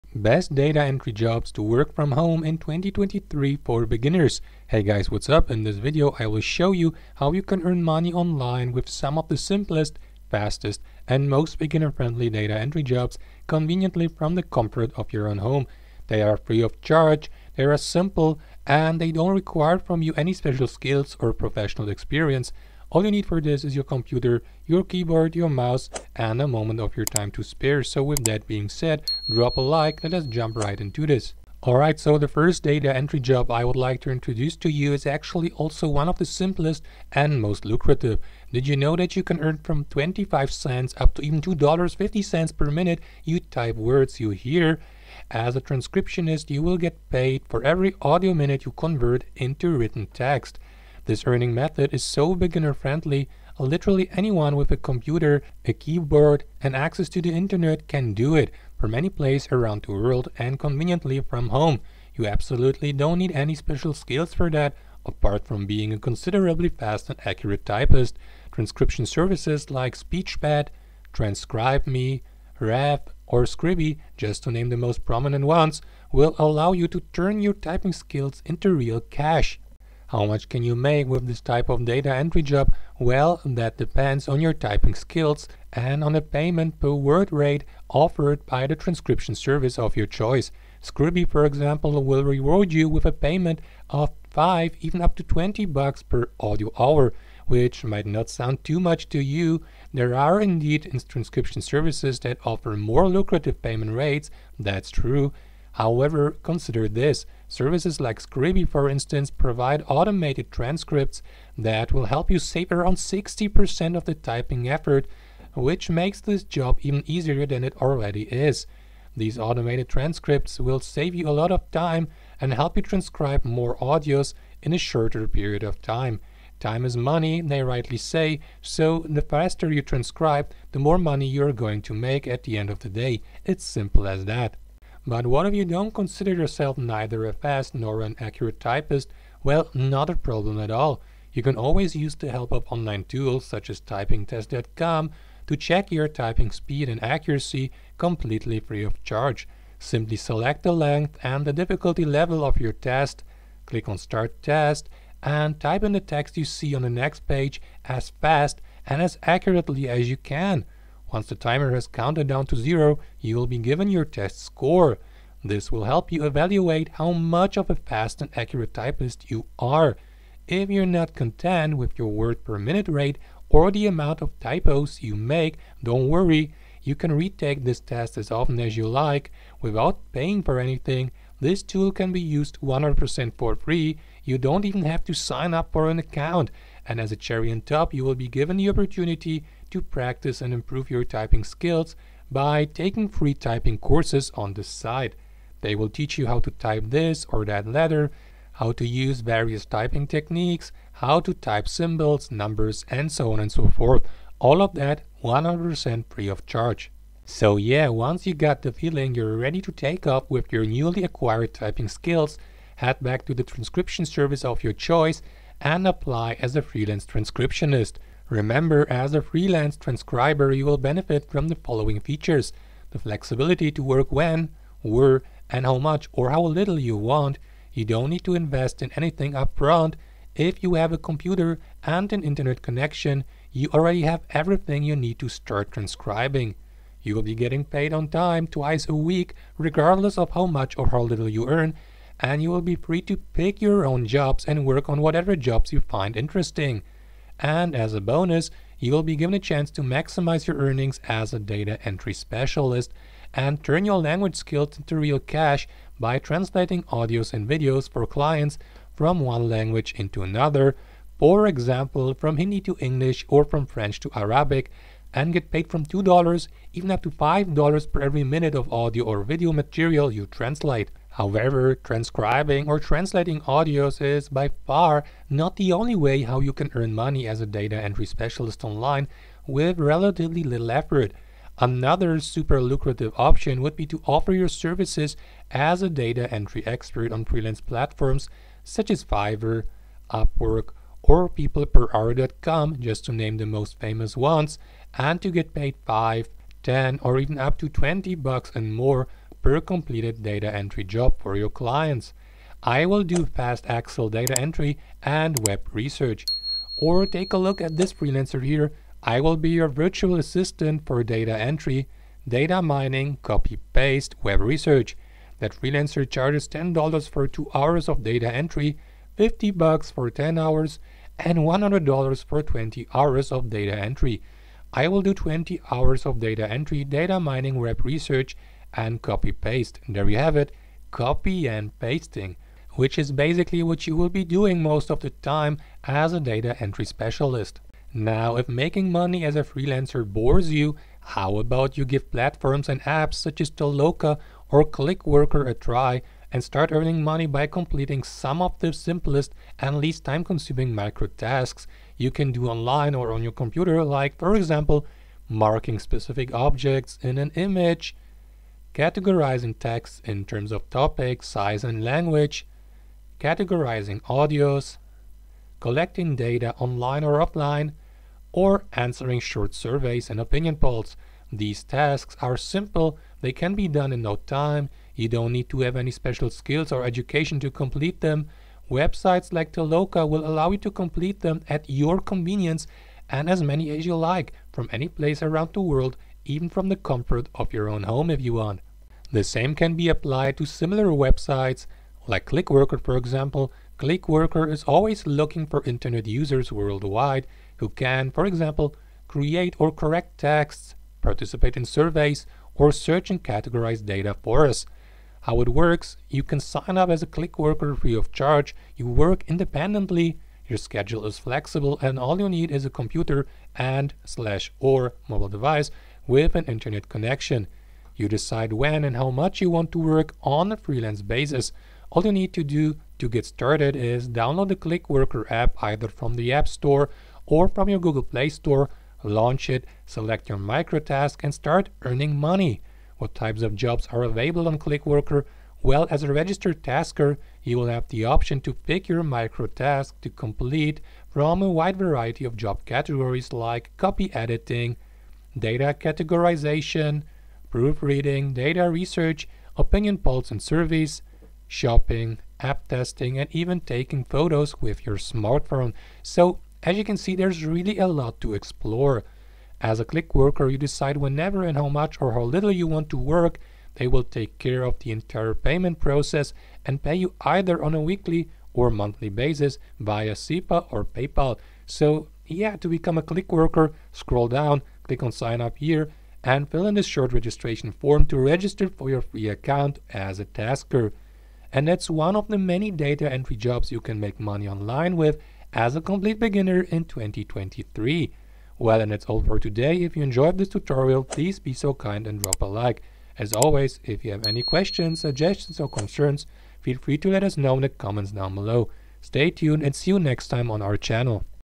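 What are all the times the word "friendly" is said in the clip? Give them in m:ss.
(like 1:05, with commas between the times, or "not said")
0:11, 0:52.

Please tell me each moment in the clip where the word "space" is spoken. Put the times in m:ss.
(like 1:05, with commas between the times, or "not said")
not said.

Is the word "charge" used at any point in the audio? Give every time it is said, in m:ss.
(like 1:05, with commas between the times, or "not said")
0:16, 2:29, 3:26, 5:16, 6:48.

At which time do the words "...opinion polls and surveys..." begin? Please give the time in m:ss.
7:29.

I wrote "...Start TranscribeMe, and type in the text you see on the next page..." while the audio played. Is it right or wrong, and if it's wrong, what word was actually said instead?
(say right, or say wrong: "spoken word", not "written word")
wrong: "Test", not "TranscribeMe".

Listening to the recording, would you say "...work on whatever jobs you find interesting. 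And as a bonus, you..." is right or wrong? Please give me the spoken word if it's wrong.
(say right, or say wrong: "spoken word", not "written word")
right.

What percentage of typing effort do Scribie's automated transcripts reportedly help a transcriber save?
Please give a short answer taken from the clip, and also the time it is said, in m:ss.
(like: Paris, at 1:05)
60%, at 1:52.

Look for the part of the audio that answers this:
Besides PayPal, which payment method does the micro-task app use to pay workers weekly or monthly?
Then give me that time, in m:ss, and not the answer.
7:50.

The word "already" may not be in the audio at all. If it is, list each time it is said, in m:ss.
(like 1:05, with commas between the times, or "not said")
1:57, 3:53.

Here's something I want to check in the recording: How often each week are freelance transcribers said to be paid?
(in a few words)
twice a week.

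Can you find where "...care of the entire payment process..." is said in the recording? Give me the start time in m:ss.
7:44.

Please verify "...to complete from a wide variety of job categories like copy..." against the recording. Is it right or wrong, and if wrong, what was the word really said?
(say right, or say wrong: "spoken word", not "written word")
right.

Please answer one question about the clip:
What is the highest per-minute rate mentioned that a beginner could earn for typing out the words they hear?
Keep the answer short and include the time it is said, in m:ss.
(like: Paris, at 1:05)
$2.50, at 0:41.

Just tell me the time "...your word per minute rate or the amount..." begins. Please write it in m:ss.
2:51.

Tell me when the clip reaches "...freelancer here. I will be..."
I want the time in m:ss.
5:07.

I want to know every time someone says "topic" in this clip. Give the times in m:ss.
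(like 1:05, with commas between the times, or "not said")
6:00.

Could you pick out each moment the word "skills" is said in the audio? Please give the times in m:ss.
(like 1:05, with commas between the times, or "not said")
0:20, 1:03, 1:17, 1:24, 3:11, 3:31, 4:14, 6:16.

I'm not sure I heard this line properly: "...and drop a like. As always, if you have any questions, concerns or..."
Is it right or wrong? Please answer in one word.
wrong.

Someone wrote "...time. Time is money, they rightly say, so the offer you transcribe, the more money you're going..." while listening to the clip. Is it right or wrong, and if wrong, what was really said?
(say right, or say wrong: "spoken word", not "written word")
wrong: "faster", not "offer".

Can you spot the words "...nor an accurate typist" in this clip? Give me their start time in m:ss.
2:17.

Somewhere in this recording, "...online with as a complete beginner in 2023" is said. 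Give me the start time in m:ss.
8:04.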